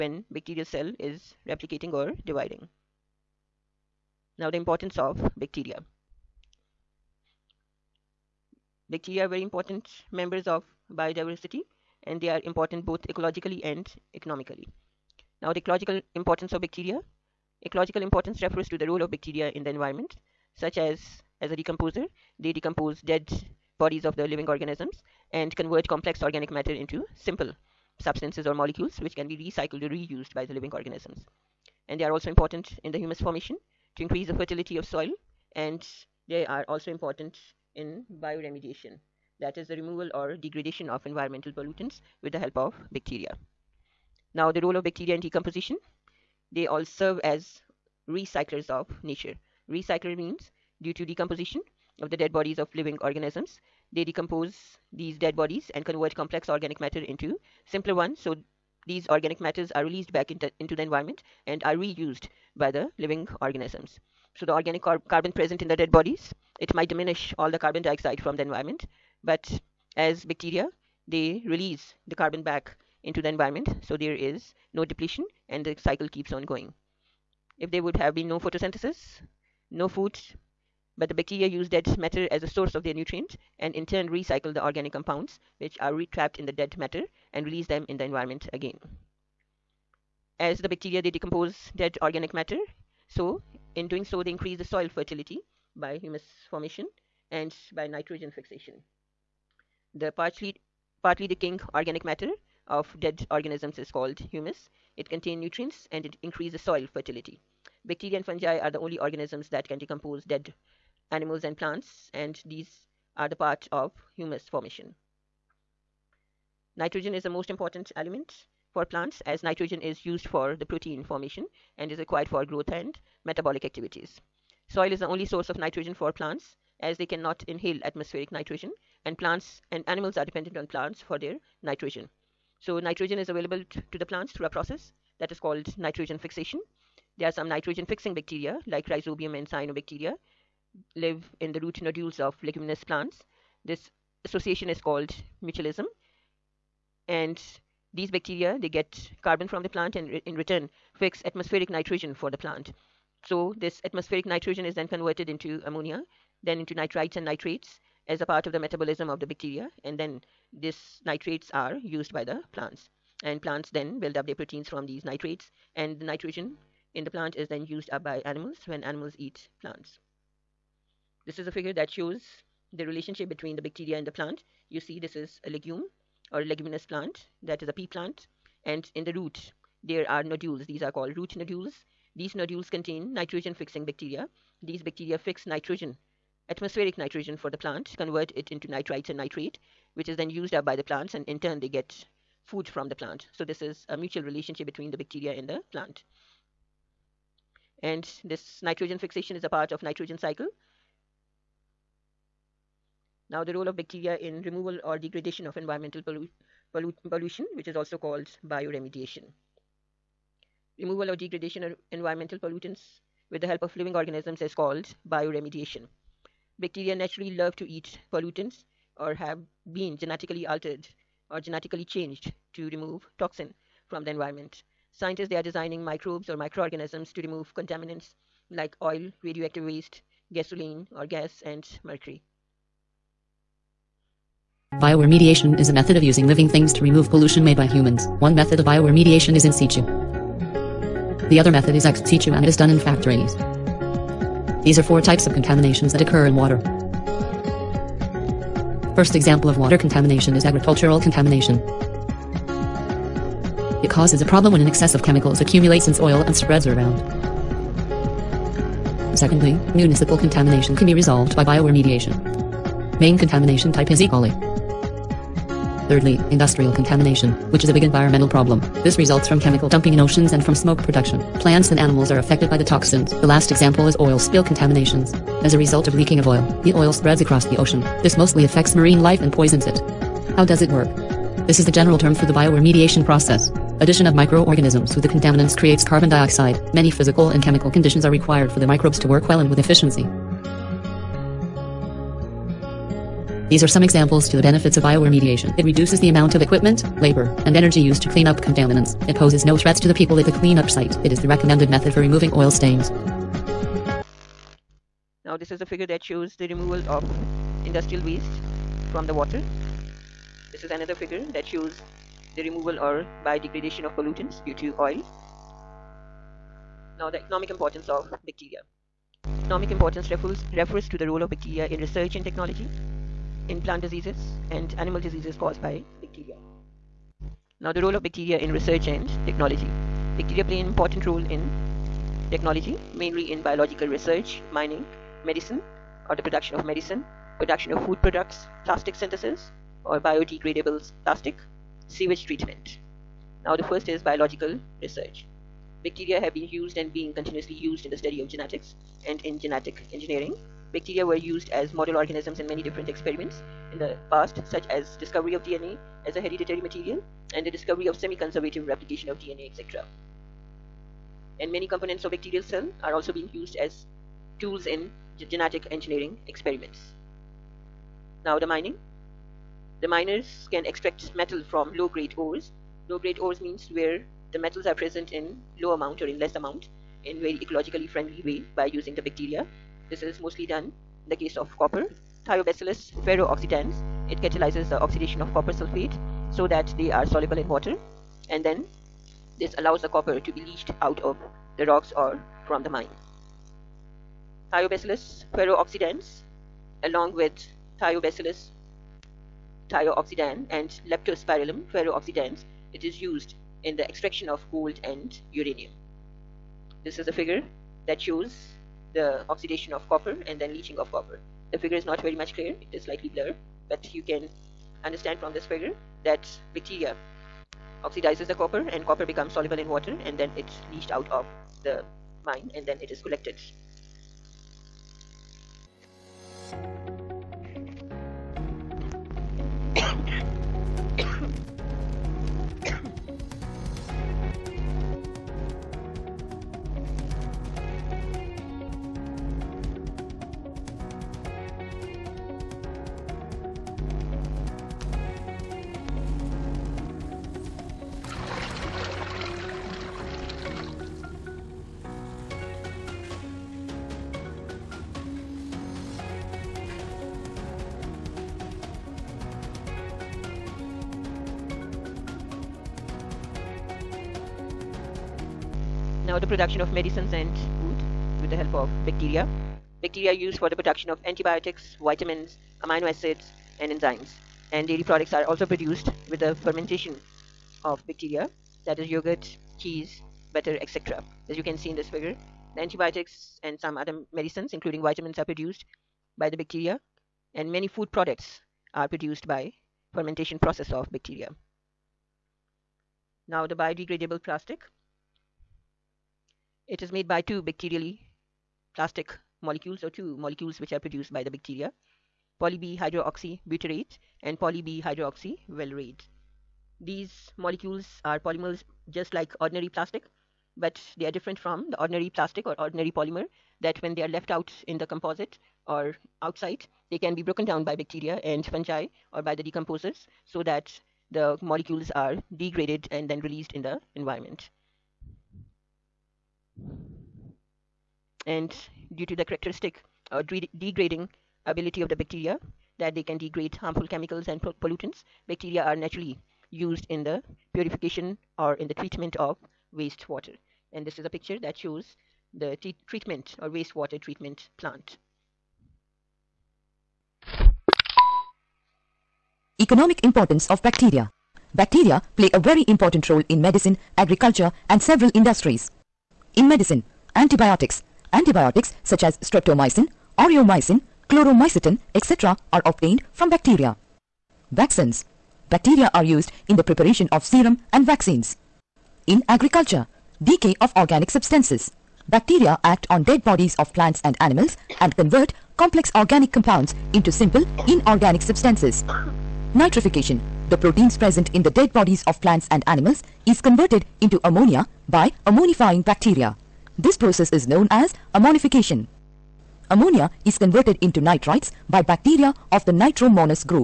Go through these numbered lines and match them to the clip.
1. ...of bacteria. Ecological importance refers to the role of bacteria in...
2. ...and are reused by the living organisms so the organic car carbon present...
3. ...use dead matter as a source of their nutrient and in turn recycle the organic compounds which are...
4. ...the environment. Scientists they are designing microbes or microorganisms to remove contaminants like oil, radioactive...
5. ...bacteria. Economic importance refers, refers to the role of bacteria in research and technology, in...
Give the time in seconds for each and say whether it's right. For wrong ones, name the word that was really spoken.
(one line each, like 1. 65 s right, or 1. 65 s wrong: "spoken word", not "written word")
1. 16 s right
2. 61 s right
3. 81 s right
4. 224 s right
5. 318 s right.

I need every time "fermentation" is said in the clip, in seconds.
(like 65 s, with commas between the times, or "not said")
476 s, 489 s.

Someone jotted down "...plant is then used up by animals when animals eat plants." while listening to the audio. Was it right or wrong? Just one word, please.
right.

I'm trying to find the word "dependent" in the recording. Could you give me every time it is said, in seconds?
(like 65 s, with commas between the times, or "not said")
130 s.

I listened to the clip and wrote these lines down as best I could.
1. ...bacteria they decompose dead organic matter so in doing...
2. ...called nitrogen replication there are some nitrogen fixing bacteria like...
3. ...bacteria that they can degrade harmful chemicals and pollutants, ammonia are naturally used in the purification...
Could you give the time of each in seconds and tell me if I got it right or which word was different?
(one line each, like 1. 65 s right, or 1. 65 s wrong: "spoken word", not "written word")
1. 90 s right
2. 135 s wrong: "fixation", not "replication"
3. 531 s wrong: "bacteria", not "ammonia".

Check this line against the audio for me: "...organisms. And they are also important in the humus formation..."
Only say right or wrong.
right.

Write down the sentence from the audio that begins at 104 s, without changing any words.
It contains nutrients and it increases soil fertility.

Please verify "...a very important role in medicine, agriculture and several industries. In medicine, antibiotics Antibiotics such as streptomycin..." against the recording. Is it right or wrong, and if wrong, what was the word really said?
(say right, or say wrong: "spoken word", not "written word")
right.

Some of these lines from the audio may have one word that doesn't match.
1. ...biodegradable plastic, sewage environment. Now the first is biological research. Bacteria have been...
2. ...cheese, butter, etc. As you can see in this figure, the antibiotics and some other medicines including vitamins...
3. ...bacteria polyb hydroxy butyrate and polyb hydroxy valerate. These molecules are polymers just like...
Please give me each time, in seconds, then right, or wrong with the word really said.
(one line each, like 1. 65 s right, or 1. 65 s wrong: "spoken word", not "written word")
1. 339 s wrong: "treatment", not "environment"
2. 479 s right
3. 501 s right.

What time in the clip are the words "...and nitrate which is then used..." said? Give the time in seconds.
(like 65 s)
189 s.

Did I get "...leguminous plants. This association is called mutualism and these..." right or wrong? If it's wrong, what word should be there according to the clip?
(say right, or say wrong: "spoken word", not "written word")
right.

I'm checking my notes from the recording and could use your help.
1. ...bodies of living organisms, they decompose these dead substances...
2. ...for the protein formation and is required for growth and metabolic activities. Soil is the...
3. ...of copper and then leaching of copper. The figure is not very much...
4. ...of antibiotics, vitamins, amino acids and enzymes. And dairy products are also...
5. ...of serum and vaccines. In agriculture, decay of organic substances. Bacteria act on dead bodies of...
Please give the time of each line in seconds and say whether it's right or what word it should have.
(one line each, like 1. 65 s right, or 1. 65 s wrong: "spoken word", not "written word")
1. 52 s wrong: "bodies", not "substances"
2. 120 s right
3. 409 s right
4. 470 s right
5. 567 s right.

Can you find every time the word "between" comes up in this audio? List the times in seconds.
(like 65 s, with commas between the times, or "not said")
173 s, 194 s.